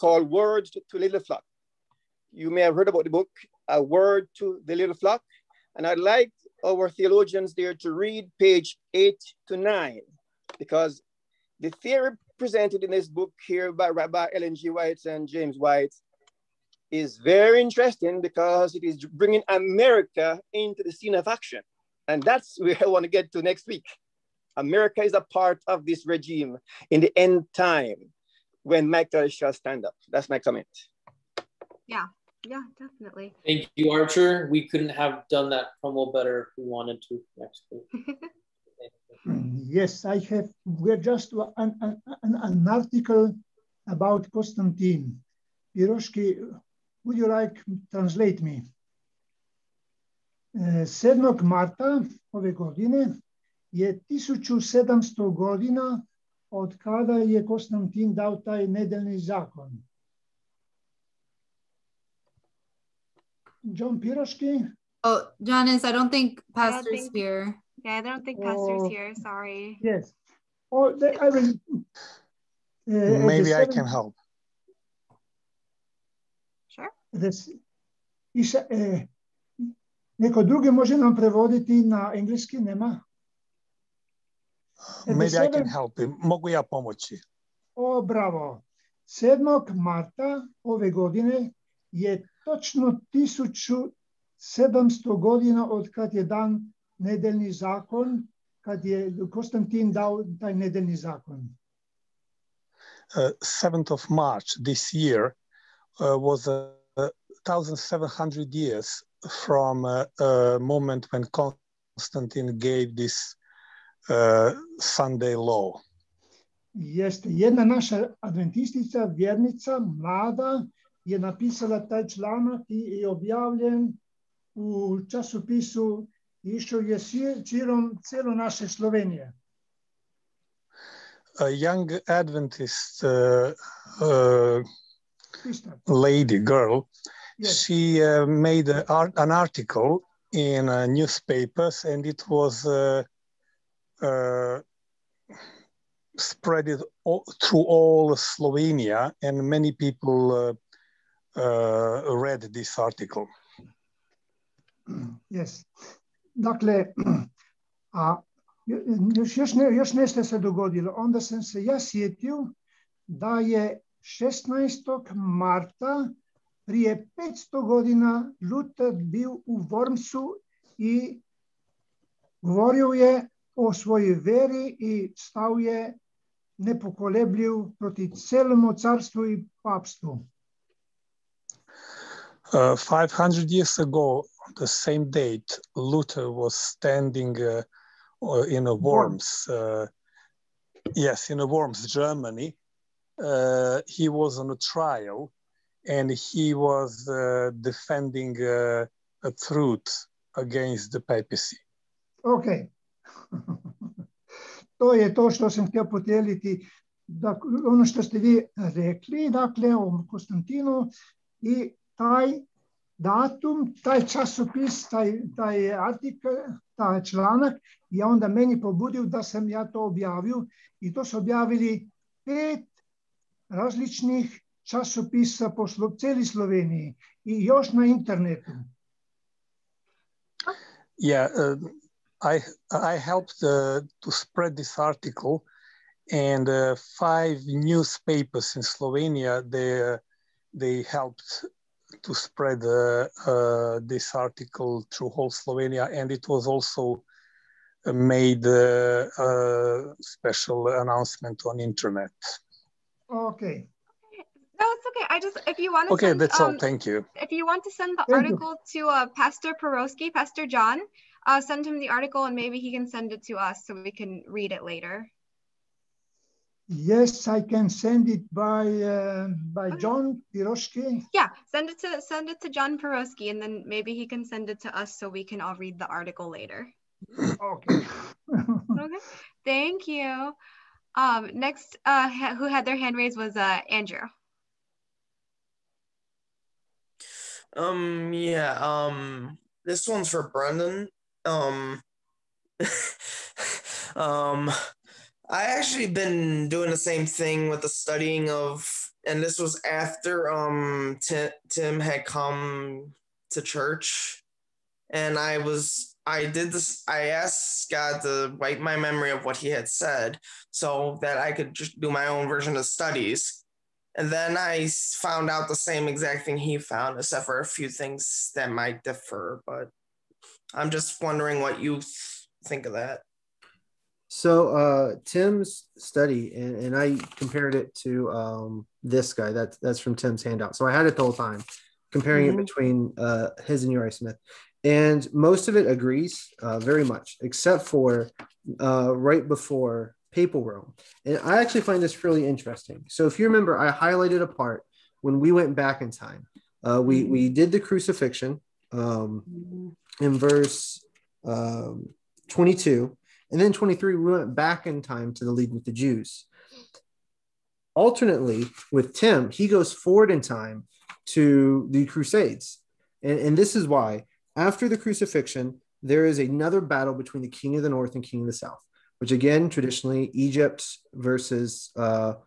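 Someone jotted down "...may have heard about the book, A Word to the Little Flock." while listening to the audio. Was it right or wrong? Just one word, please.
right.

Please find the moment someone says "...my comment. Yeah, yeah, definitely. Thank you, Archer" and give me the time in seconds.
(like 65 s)
30 s.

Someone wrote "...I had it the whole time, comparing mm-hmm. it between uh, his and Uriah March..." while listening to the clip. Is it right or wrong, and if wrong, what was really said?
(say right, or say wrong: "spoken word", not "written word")
wrong: "Smith", not "March".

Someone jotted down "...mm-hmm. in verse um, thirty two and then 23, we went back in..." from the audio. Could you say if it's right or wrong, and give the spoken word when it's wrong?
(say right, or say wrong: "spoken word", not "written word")
wrong: "twenty", not "thirty".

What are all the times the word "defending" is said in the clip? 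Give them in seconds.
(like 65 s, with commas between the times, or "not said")
197 s.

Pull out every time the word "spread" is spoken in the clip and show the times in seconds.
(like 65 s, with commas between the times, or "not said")
146 s, 234 s, 242 s.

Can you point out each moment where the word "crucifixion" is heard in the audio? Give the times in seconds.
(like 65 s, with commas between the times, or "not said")
347 s, 364 s.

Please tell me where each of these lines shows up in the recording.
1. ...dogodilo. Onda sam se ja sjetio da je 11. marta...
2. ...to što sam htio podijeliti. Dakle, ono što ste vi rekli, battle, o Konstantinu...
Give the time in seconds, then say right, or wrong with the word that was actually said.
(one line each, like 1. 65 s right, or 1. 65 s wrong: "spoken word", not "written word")
1. 160 s wrong: "16", not "11"
2. 205 s wrong: "dakle", not "battle".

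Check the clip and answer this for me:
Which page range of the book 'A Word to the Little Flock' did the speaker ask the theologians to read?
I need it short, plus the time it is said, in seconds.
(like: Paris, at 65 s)
pages 8 to 9, at 8 s.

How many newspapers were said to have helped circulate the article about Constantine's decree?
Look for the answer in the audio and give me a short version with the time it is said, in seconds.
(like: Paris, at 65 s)
5, at 236 s.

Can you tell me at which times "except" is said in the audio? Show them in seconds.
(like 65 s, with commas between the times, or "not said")
316 s, 337 s.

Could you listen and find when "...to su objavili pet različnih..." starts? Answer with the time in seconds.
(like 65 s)
220 s.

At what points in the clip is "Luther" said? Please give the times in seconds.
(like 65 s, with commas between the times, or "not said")
168 s, 185 s.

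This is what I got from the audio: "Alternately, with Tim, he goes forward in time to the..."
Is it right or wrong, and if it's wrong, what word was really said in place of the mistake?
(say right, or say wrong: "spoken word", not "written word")
right.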